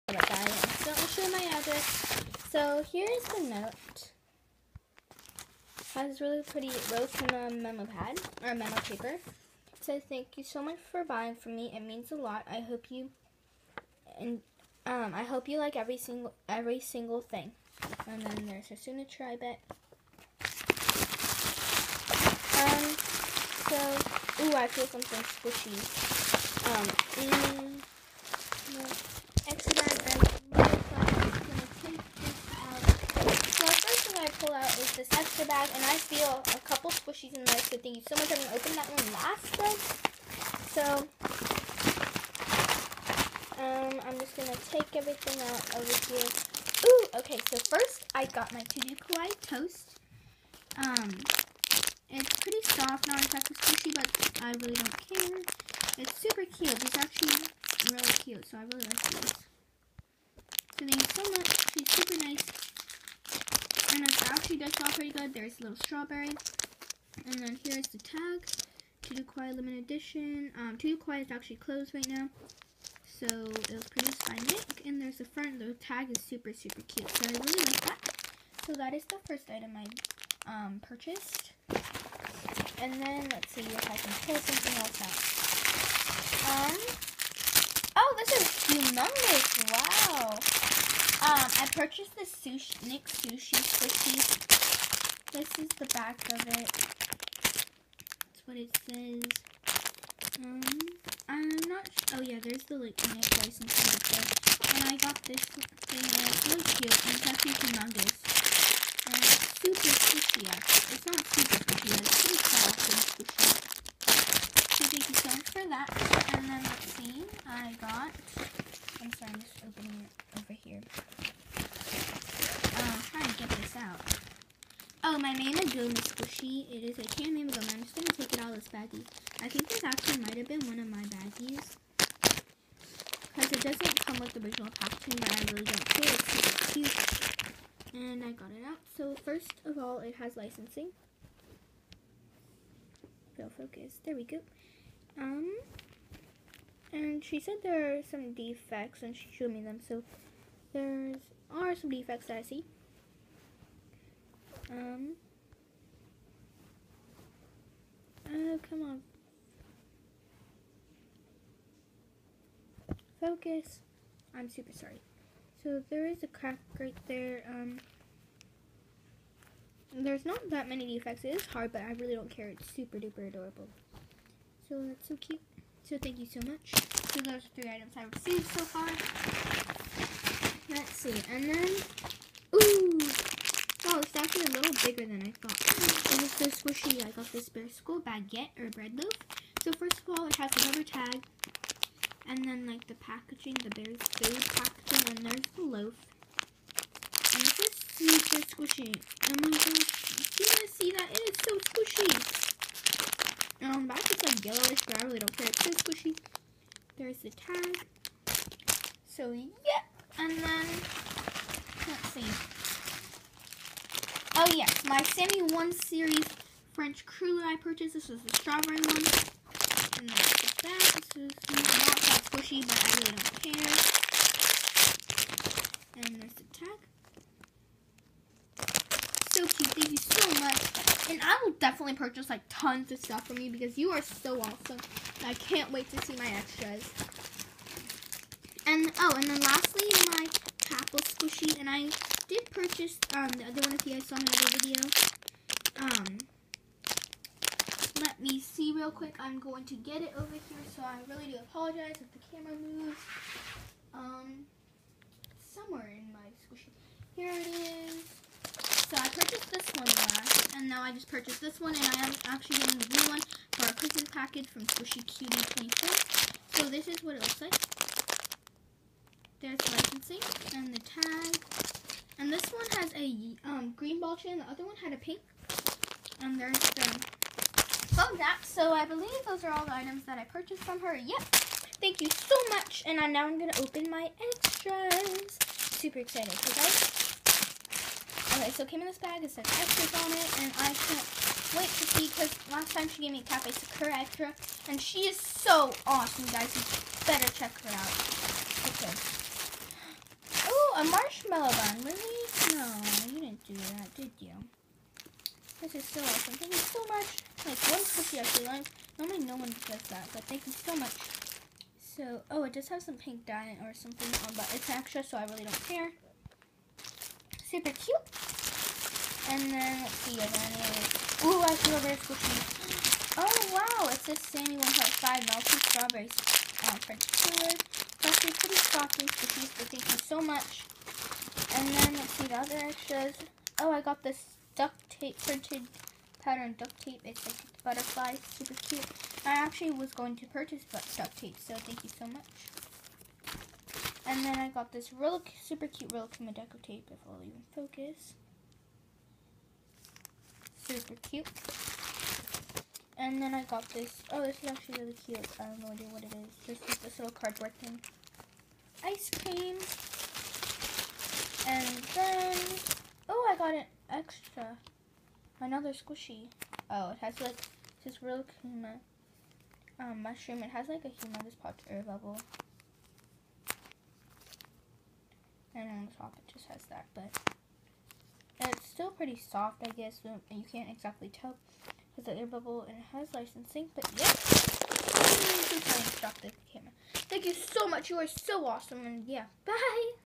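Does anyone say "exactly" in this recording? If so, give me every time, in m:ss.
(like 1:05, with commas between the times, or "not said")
0:53, 6:20.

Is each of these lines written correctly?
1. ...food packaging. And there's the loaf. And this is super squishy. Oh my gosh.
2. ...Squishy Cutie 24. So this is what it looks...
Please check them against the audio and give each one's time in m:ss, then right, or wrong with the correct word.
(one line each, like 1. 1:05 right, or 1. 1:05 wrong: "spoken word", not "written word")
1. 3:13 right
2. 4:24 right.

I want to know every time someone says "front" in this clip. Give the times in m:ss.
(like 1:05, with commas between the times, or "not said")
1:15.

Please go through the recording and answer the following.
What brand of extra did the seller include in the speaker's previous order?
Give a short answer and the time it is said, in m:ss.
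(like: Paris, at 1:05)
Cafe Sakura, at 4:53.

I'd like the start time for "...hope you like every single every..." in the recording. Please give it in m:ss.
0:15.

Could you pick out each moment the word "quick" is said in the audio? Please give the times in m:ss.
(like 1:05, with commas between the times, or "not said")
4:08.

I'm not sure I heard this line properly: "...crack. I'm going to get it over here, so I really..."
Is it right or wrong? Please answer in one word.
wrong.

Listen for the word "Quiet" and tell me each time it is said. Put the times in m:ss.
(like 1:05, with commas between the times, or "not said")
1:09.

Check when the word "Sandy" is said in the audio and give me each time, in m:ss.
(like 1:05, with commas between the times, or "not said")
5:24.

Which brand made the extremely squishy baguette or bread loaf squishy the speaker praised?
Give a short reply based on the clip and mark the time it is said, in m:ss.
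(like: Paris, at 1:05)
Bear School, at 3:07.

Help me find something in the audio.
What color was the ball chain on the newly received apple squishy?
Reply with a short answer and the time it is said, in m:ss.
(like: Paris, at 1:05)
green, at 4:33.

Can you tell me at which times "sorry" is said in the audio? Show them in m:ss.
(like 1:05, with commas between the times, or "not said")
1:59, 2:44.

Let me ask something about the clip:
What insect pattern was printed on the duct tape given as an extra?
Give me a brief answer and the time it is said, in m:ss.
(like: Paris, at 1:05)
butterfly, at 5:37.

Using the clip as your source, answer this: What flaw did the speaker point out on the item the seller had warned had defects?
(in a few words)
a crack.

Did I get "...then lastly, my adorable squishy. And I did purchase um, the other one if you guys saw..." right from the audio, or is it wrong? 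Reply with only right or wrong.
wrong.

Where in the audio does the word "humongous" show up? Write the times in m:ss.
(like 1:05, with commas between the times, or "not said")
1:47, 6:10.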